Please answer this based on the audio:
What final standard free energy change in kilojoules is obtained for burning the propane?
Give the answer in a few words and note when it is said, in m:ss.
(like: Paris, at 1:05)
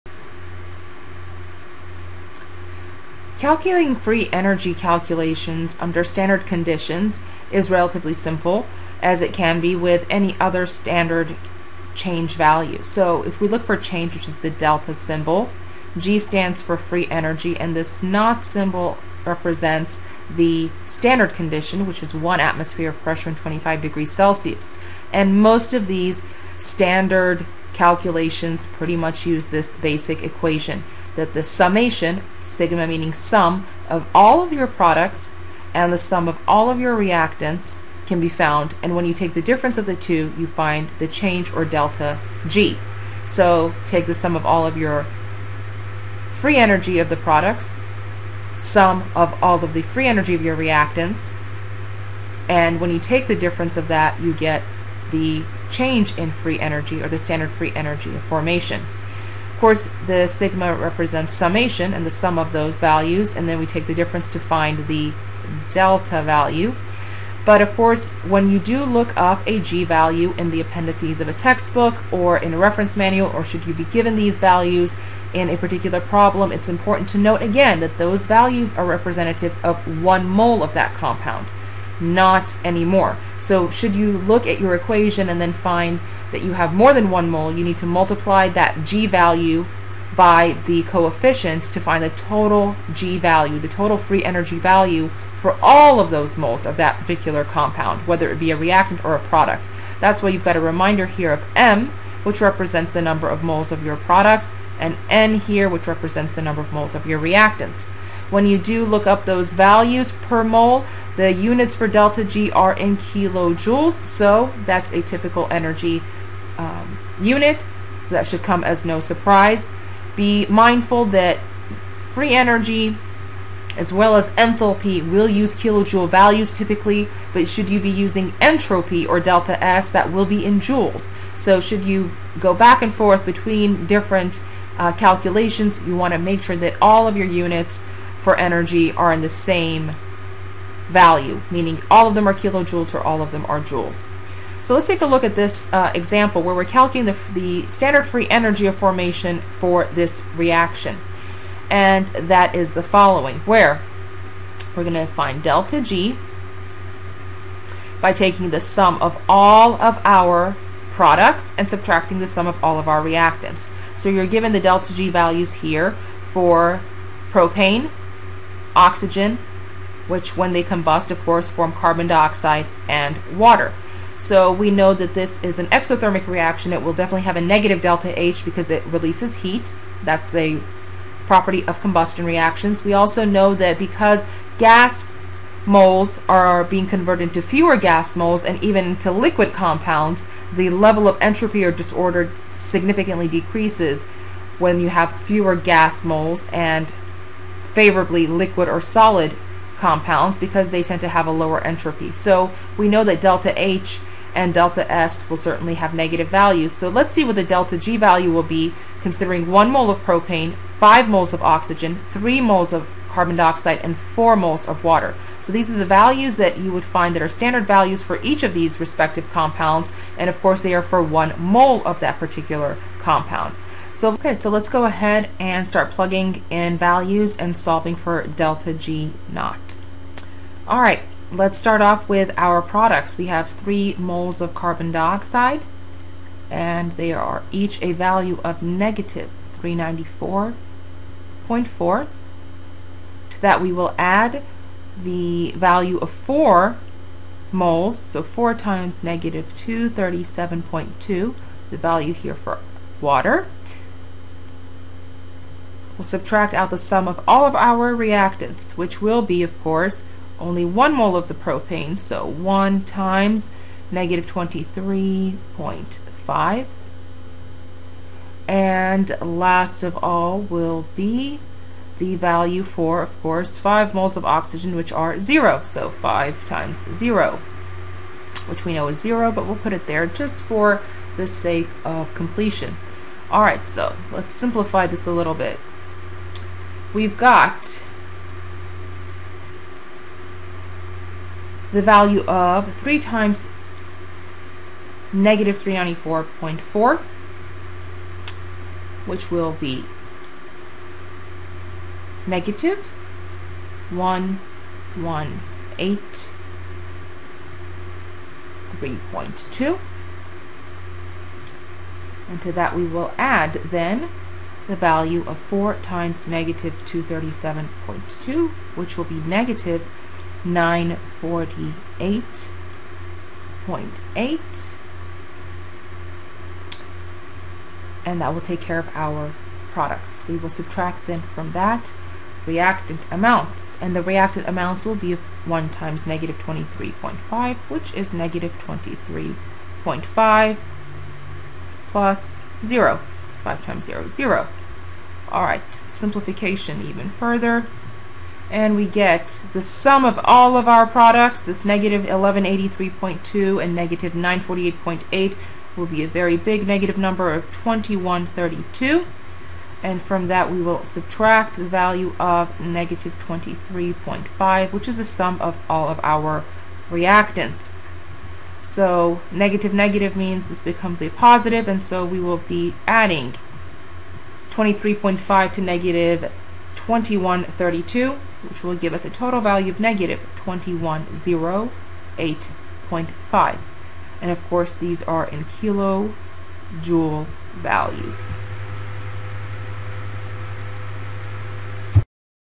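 -2108.5, at 6:19.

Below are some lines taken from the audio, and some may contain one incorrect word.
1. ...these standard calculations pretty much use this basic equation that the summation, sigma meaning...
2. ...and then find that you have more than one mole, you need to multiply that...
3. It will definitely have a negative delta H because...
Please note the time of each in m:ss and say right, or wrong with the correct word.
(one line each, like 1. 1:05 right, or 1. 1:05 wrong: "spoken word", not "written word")
1. 0:25 right
2. 1:25 right
3. 2:56 right.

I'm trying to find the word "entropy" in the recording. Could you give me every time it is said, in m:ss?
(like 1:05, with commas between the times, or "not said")
2:08, 3:11, 3:21.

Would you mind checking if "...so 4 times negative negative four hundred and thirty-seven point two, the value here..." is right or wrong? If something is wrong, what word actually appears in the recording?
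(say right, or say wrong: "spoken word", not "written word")
wrong: "two", not "four".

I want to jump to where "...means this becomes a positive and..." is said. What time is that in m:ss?
6:10.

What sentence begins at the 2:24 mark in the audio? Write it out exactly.
So let's take a look at this uh, example where we're calculating the, the standard free energy of formation for this reaction.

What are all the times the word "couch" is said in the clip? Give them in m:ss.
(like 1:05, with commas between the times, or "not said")
not said.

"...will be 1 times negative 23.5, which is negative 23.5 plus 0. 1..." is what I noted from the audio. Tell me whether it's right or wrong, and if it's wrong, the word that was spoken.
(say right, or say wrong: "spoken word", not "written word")
wrong: "5", not "1".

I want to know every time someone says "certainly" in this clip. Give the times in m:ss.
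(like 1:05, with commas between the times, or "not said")
3:25.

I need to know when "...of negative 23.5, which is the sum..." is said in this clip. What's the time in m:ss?
6:02.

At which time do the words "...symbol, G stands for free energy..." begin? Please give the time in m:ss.
0:14.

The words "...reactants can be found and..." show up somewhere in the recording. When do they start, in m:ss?
0:36.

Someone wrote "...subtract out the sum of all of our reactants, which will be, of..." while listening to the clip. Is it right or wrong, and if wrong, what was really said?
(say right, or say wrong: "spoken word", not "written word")
right.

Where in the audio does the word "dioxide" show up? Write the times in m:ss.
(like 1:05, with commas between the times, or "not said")
2:52, 3:33, 3:54.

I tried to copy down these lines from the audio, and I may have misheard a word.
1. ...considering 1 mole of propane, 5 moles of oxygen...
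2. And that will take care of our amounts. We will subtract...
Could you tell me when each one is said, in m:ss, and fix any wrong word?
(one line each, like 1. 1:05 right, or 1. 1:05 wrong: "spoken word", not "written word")
1. 3:29 right
2. 5:28 wrong: "products", not "amounts".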